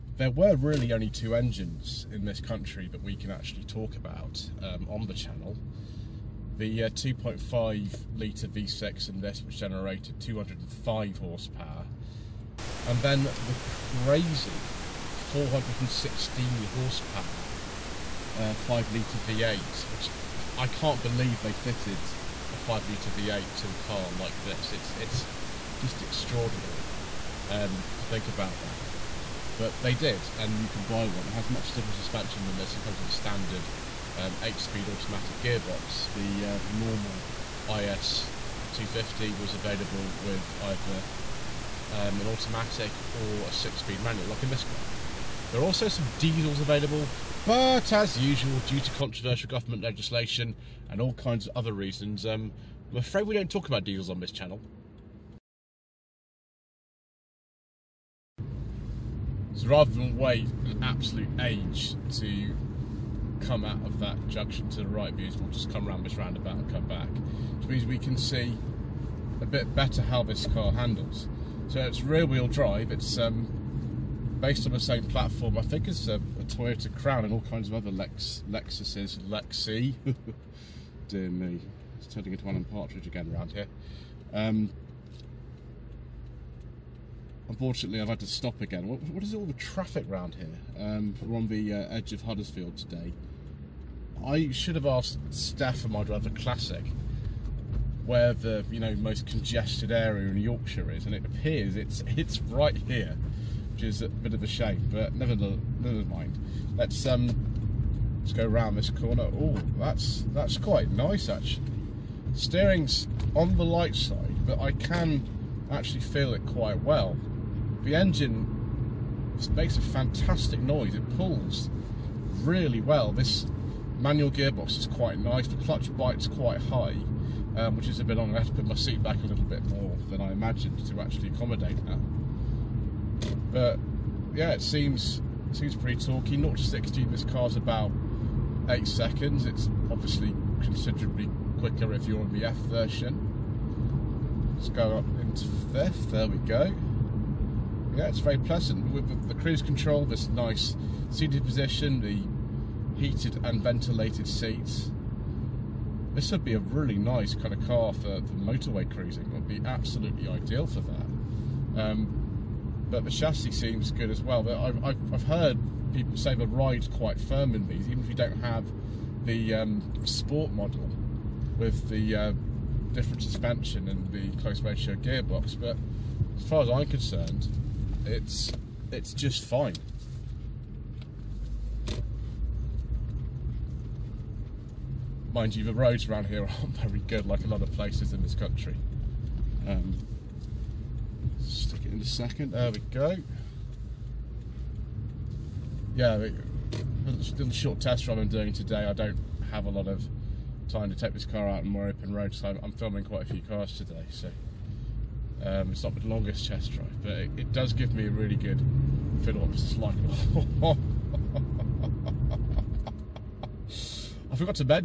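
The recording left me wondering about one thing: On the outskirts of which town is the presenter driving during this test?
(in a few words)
Huddersfield.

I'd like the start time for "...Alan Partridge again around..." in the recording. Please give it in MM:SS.
01:22.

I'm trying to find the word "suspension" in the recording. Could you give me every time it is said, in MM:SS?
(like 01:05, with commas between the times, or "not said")
00:31, 02:53.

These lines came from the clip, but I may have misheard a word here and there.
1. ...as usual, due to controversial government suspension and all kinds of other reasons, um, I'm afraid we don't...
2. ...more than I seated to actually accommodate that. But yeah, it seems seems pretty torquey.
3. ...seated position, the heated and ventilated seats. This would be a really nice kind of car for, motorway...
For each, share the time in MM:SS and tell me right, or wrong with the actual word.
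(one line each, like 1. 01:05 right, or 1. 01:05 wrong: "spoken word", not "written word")
1. 00:47 wrong: "legislation", not "suspension"
2. 02:09 wrong: "imagined", not "seated"
3. 02:31 right.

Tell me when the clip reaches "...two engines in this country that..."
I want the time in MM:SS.
00:01.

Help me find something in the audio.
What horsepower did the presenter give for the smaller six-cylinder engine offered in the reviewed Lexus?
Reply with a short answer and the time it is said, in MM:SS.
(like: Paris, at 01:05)
205, at 00:10.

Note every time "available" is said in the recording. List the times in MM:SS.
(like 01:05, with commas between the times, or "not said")
00:39, 00:46.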